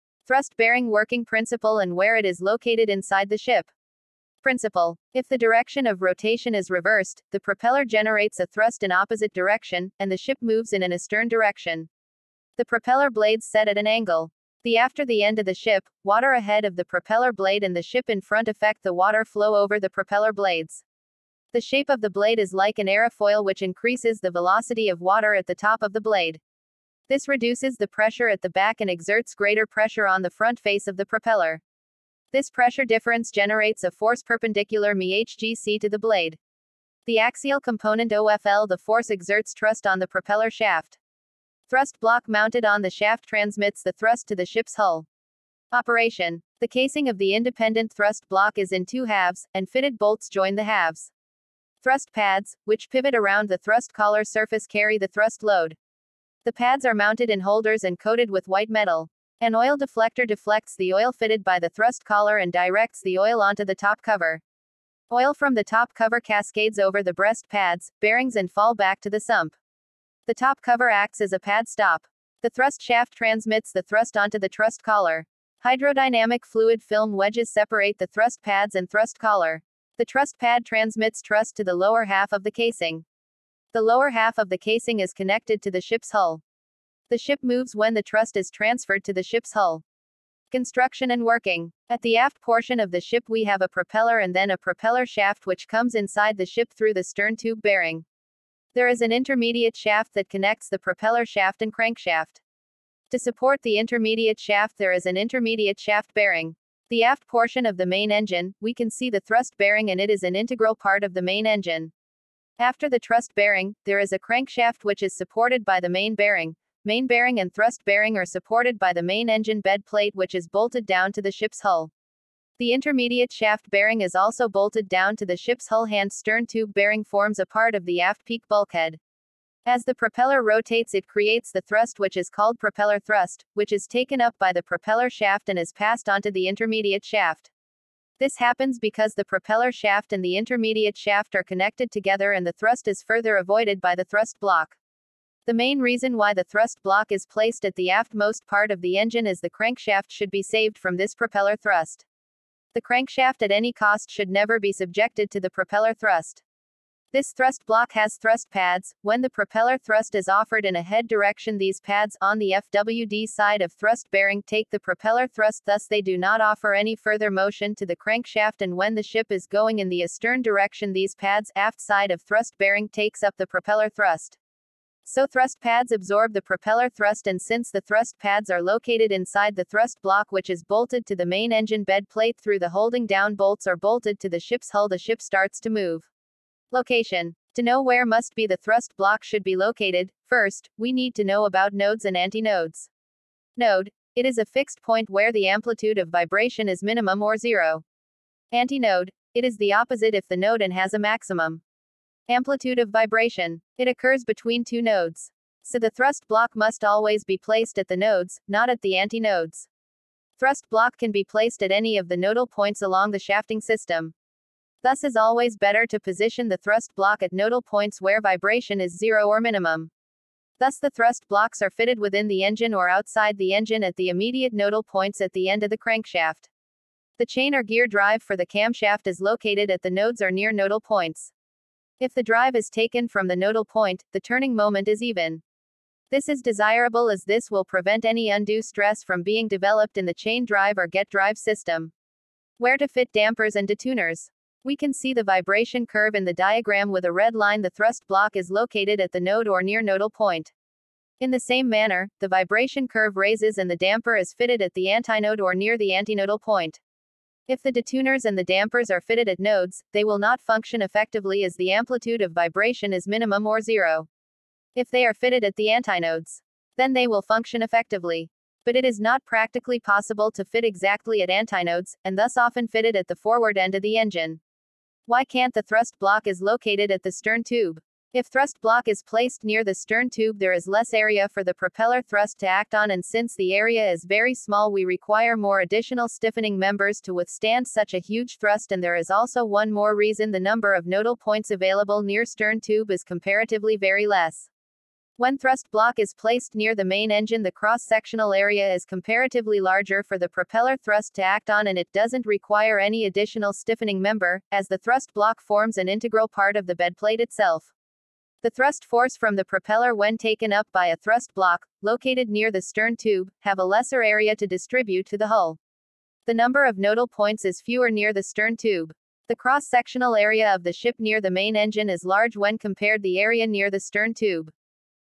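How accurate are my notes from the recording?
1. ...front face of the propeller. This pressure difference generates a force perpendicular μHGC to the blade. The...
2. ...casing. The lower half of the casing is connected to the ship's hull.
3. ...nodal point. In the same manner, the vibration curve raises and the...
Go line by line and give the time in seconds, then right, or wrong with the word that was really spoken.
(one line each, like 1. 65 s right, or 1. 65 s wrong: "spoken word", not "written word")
1. 30 s right
2. 82 s right
3. 249 s right.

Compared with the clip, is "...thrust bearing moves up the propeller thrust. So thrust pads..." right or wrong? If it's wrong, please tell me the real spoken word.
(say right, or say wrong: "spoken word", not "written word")
wrong: "takes", not "moves".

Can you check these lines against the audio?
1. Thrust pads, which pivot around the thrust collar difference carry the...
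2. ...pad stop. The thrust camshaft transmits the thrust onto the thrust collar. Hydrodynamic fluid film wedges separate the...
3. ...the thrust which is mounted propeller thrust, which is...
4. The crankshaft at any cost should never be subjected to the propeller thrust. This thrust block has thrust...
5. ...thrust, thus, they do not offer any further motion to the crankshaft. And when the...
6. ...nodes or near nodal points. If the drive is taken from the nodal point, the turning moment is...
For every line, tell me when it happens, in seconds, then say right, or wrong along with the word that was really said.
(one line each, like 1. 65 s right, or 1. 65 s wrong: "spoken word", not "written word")
1. 51 s wrong: "surface", not "difference"
2. 71 s wrong: "shaft", not "camshaft"
3. 131 s wrong: "called", not "mounted"
4. 152 s right
5. 165 s right
6. 229 s right.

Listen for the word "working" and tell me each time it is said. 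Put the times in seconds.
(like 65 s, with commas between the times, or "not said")
0 s, 91 s.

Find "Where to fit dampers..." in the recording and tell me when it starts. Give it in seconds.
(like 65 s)
242 s.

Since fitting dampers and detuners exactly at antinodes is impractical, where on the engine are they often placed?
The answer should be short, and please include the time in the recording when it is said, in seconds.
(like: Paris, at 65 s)
Forward end of the engine, at 273 s.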